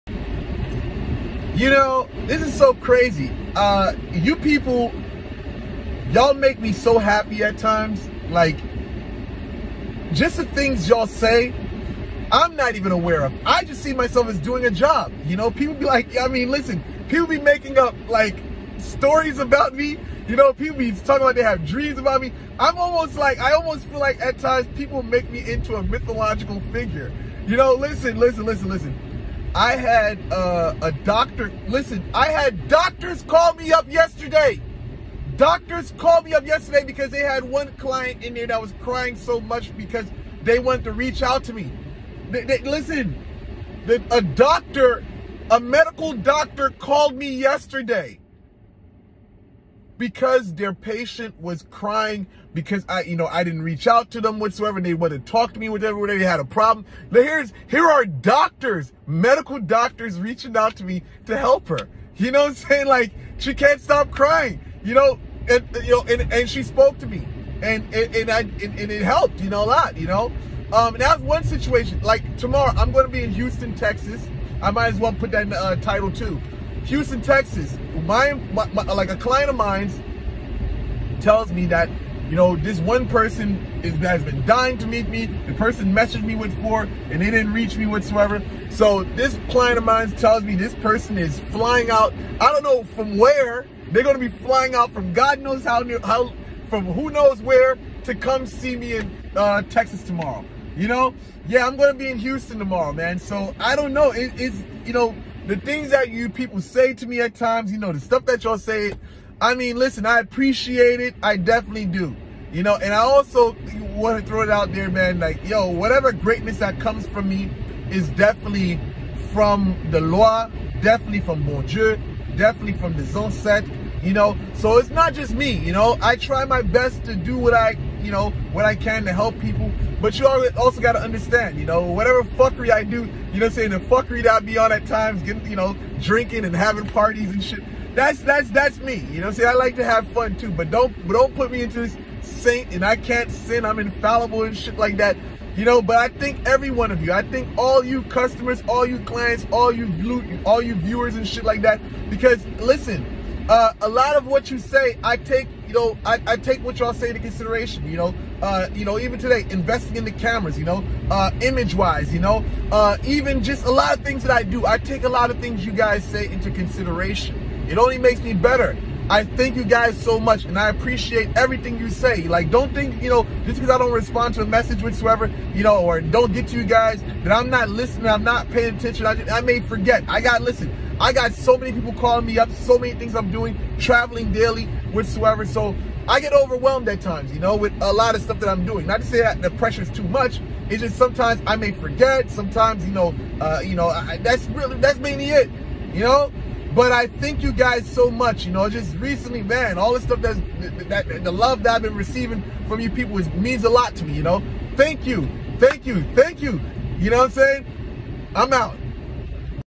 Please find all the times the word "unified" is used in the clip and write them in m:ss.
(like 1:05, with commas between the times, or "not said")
not said.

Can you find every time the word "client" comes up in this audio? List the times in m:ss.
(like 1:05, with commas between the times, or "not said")
0:37, 1:19, 1:29, 2:28.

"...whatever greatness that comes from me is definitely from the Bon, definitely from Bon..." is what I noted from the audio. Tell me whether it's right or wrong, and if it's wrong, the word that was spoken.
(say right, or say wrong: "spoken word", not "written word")
wrong: "Lwa", not "Bon".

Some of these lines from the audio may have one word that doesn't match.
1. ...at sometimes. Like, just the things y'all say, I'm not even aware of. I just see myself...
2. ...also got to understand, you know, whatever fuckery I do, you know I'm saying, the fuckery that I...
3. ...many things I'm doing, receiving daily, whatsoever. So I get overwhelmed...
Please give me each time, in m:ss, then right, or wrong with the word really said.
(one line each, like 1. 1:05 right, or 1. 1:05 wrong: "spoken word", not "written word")
1. 0:07 wrong: "times", not "sometimes"
2. 2:10 right
3. 3:02 wrong: "traveling", not "receiving".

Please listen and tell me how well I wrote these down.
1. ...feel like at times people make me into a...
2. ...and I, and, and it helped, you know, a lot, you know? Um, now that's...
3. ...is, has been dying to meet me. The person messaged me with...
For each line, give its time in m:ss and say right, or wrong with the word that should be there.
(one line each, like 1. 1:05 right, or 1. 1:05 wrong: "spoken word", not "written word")
1. 0:23 right
2. 1:08 right
3. 1:23 right.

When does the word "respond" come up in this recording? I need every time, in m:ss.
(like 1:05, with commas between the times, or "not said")
2:53.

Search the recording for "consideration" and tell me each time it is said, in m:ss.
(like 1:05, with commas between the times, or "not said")
2:37, 2:46.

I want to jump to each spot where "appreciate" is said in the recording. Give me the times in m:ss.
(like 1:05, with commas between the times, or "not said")
1:50, 2:50.